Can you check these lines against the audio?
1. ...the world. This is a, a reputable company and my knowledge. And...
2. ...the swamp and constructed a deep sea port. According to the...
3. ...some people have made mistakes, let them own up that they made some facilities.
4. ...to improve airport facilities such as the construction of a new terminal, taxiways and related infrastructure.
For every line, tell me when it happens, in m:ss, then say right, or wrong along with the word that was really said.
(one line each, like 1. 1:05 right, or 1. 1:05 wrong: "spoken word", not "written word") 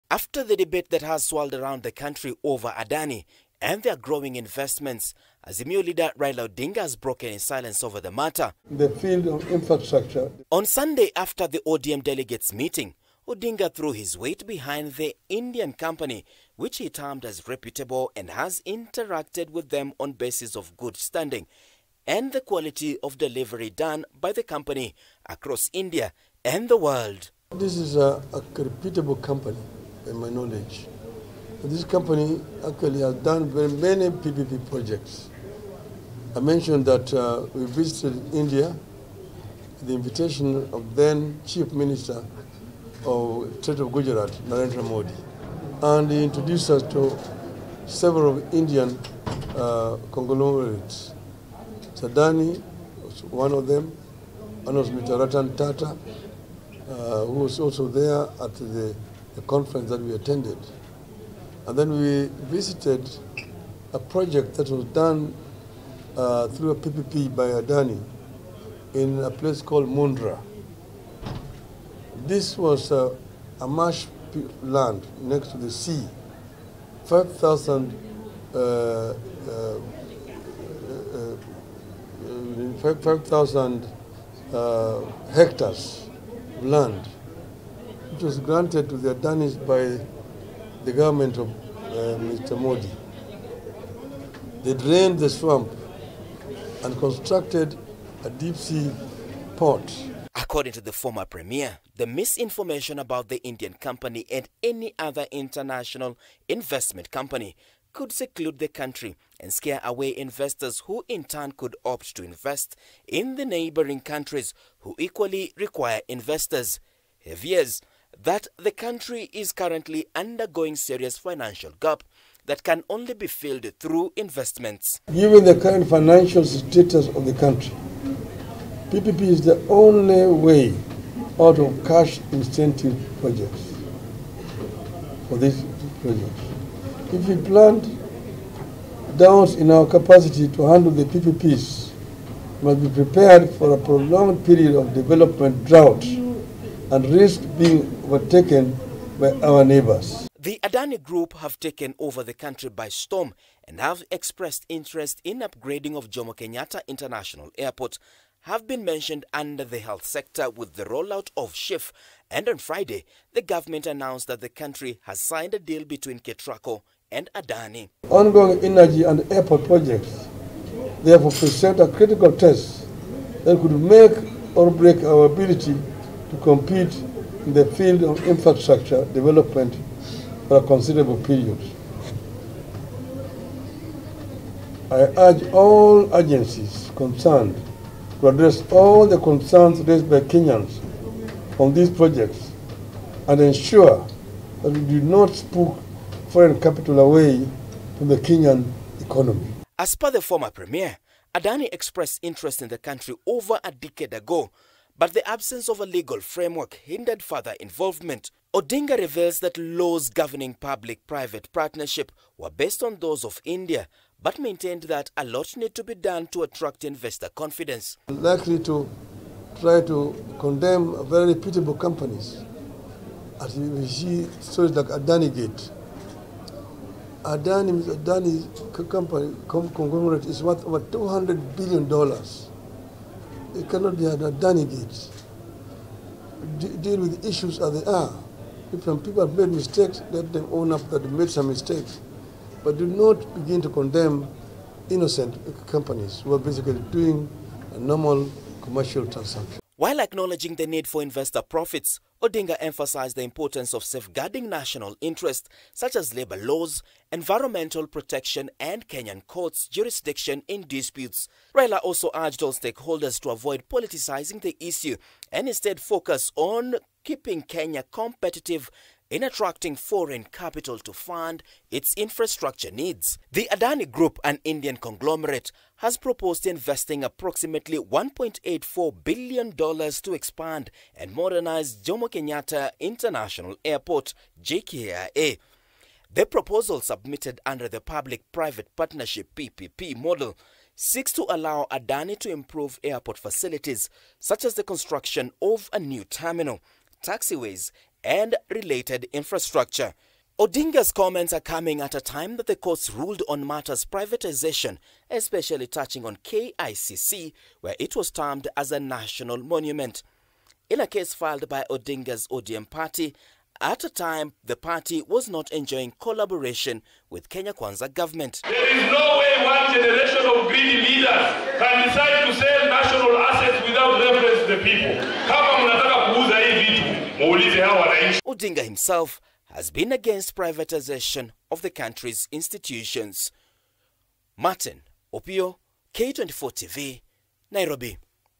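1. 0:26 right
2. 1:35 right
3. 3:58 wrong: "mistakes", not "facilities"
4. 4:52 right.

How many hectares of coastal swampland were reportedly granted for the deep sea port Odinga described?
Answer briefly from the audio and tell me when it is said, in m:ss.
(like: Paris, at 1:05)
5,000, at 1:22.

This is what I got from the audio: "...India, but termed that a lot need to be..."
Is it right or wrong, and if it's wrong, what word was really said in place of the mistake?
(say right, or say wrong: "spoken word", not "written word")
wrong: "maintained", not "termed".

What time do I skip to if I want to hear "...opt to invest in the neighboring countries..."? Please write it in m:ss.
1:51.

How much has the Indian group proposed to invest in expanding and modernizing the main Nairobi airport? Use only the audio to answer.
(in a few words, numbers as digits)
$1.84 billion.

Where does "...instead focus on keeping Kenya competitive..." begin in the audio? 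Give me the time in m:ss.
4:25.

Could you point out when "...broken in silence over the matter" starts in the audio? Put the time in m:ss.
0:06.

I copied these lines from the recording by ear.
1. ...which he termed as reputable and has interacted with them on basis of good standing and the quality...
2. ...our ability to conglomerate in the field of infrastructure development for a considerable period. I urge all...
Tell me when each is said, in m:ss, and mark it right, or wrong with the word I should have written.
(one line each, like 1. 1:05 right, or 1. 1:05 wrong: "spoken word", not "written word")
1. 0:16 right
2. 2:55 wrong: "compete", not "conglomerate".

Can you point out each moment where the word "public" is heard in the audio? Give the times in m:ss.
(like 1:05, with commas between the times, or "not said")
3:30, 4:47.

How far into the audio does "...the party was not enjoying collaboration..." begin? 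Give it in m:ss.
5:14.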